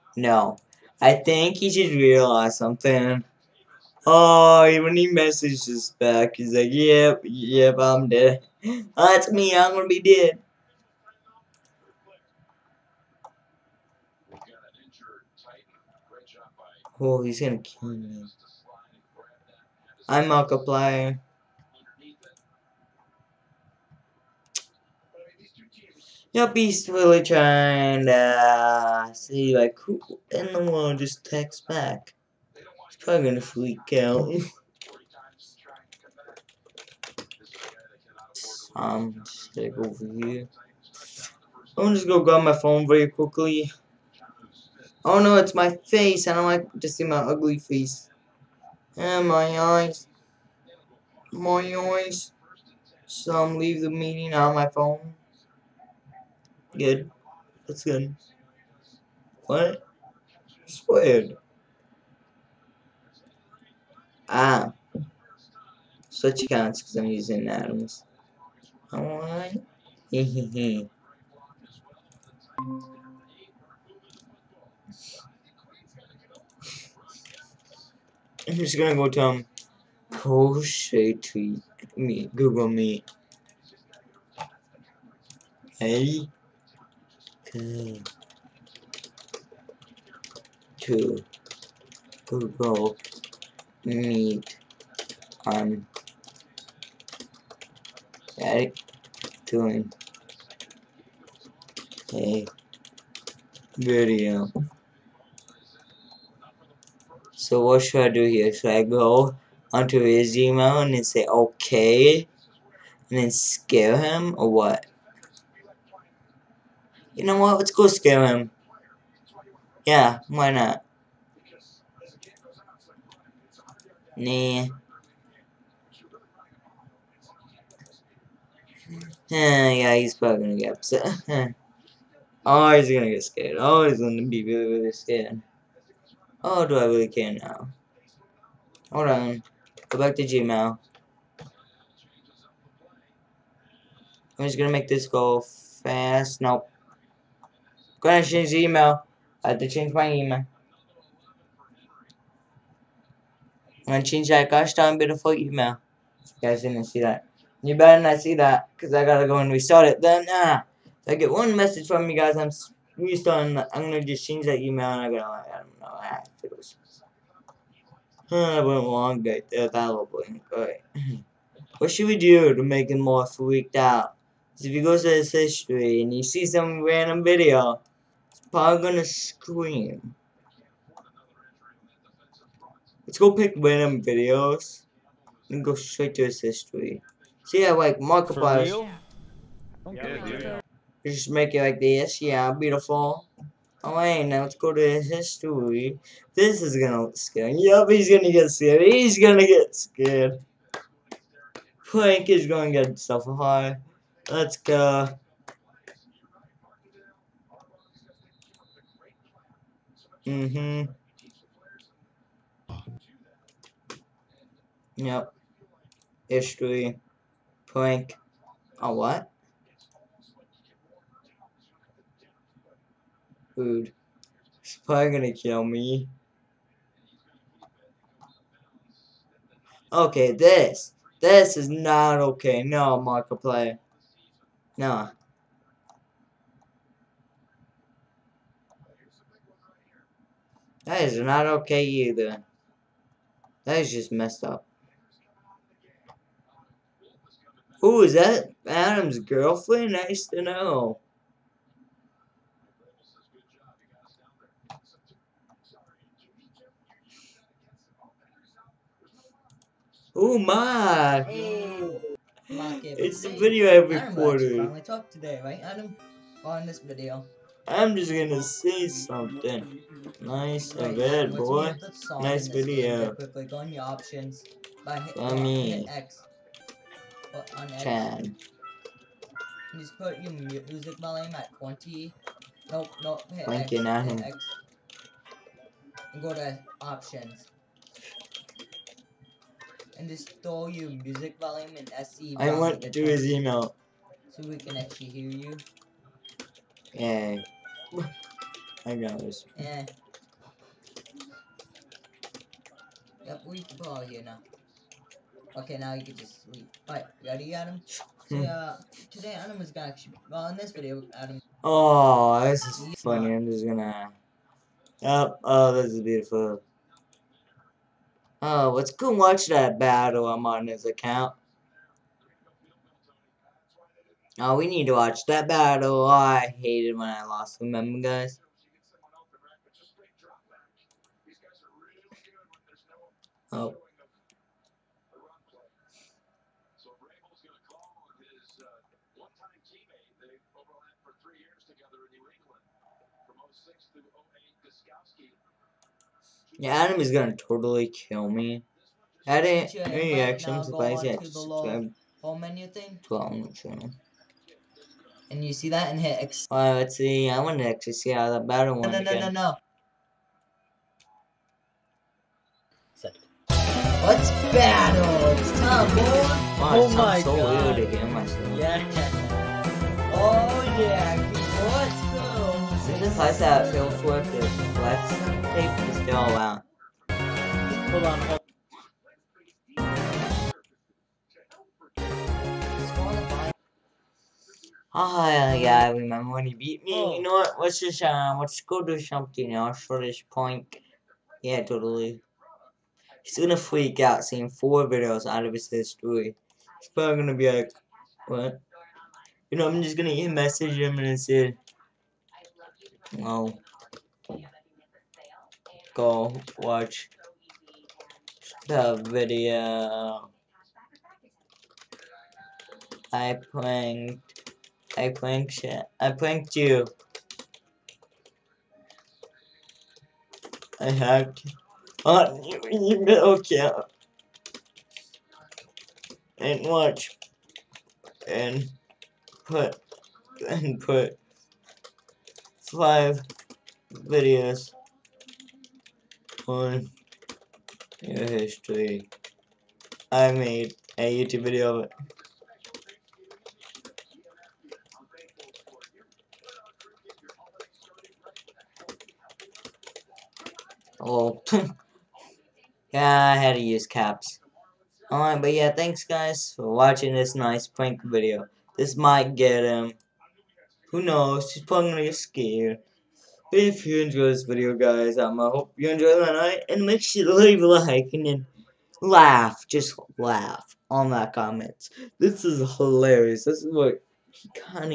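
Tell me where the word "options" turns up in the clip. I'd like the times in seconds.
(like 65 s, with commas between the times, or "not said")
273 s, 286 s.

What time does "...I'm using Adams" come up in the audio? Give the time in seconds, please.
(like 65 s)
66 s.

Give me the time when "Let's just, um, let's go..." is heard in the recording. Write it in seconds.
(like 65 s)
387 s.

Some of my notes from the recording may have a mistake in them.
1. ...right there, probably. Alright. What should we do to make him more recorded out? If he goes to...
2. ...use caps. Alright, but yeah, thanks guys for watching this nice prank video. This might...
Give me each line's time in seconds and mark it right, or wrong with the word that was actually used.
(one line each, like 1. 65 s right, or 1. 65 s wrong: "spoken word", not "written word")
1. 169 s wrong: "freaked", not "recorded"
2. 453 s right.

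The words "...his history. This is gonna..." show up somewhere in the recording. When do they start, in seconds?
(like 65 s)
194 s.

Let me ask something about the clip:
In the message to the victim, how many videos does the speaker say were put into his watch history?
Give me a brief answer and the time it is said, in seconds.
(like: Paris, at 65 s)
5, at 432 s.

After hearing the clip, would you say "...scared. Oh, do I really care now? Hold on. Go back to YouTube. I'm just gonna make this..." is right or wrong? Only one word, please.
wrong.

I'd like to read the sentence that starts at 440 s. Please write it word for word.
I made a YouTube video of it.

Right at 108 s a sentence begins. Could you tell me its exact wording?
Should I go onto his email and then say okay and then scare him or what?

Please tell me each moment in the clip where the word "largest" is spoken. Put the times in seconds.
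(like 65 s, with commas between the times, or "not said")
not said.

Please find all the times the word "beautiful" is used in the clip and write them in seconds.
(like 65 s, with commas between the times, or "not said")
154 s, 192 s, 315 s.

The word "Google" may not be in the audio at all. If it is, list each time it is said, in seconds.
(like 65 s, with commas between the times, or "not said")
82 s, 92 s.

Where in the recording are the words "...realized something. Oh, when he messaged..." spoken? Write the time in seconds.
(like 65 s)
1 s.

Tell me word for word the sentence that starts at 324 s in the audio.
Oh, we need to watch that battle.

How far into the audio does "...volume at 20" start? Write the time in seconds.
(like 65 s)
280 s.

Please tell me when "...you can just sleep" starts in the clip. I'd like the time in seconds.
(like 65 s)
305 s.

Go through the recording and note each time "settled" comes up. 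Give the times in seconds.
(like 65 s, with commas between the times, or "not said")
not said.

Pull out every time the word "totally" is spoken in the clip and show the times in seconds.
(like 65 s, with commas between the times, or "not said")
347 s, 391 s.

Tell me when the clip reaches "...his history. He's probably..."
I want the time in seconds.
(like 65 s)
395 s.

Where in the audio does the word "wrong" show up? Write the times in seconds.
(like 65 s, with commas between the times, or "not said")
not said.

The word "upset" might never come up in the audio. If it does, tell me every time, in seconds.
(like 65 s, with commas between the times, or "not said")
130 s.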